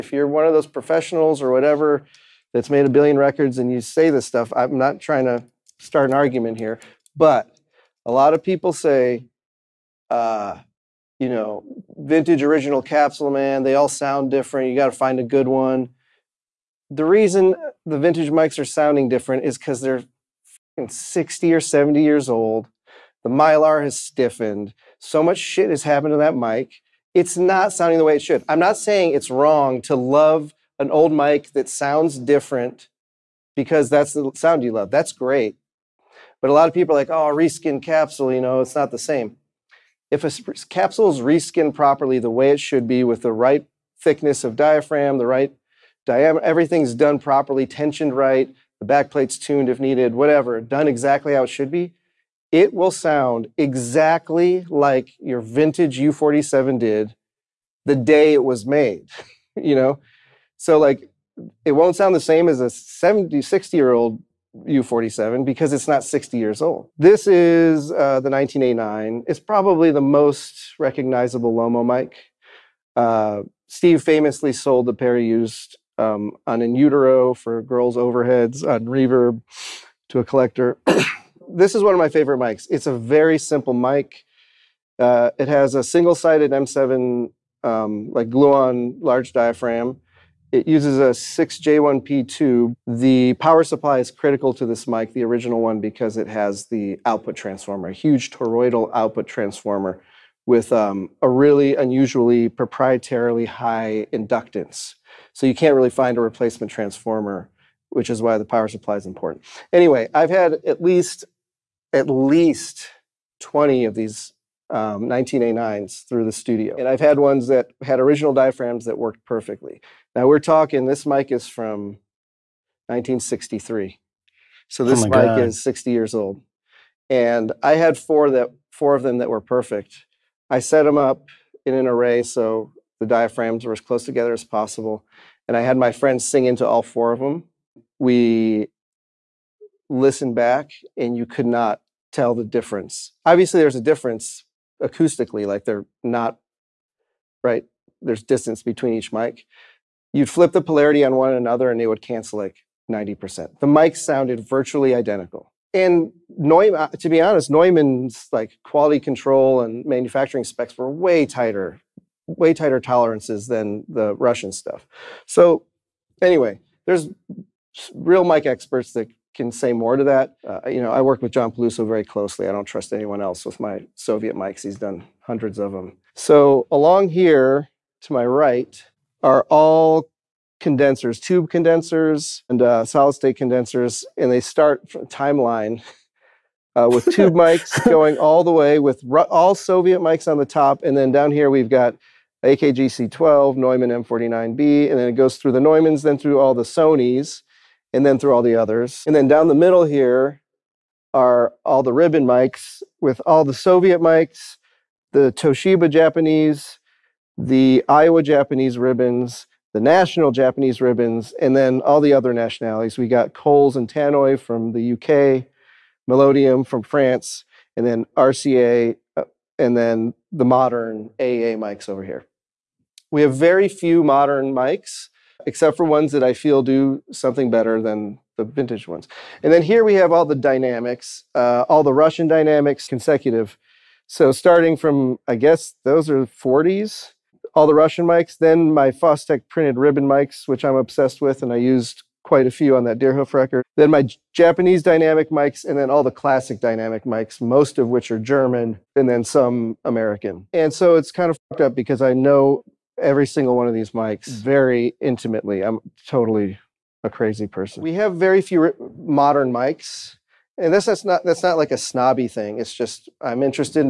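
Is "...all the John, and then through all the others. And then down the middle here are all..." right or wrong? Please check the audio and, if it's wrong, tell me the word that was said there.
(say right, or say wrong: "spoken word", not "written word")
wrong: "Sonys", not "John".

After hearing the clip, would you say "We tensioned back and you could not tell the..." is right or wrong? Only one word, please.
wrong.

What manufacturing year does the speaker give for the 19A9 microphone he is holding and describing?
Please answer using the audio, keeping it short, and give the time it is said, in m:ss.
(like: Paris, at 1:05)
1963, at 2:02.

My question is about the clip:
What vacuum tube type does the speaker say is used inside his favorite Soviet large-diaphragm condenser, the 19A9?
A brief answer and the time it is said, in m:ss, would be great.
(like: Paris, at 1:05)
6J1P, at 1:31.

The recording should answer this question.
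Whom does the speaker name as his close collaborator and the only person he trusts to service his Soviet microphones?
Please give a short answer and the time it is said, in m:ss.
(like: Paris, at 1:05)
John Peluso, at 2:51.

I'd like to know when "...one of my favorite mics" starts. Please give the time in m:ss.
1:21.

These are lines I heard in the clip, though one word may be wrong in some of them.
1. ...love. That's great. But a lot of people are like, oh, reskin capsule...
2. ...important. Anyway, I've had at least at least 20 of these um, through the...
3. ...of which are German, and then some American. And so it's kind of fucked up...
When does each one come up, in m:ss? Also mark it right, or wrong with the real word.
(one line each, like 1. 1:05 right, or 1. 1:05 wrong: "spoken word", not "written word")
1. 0:34 right
2. 1:49 right
3. 4:07 right.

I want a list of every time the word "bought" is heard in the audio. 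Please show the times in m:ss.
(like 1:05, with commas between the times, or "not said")
not said.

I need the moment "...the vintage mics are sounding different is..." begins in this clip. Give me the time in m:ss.
0:17.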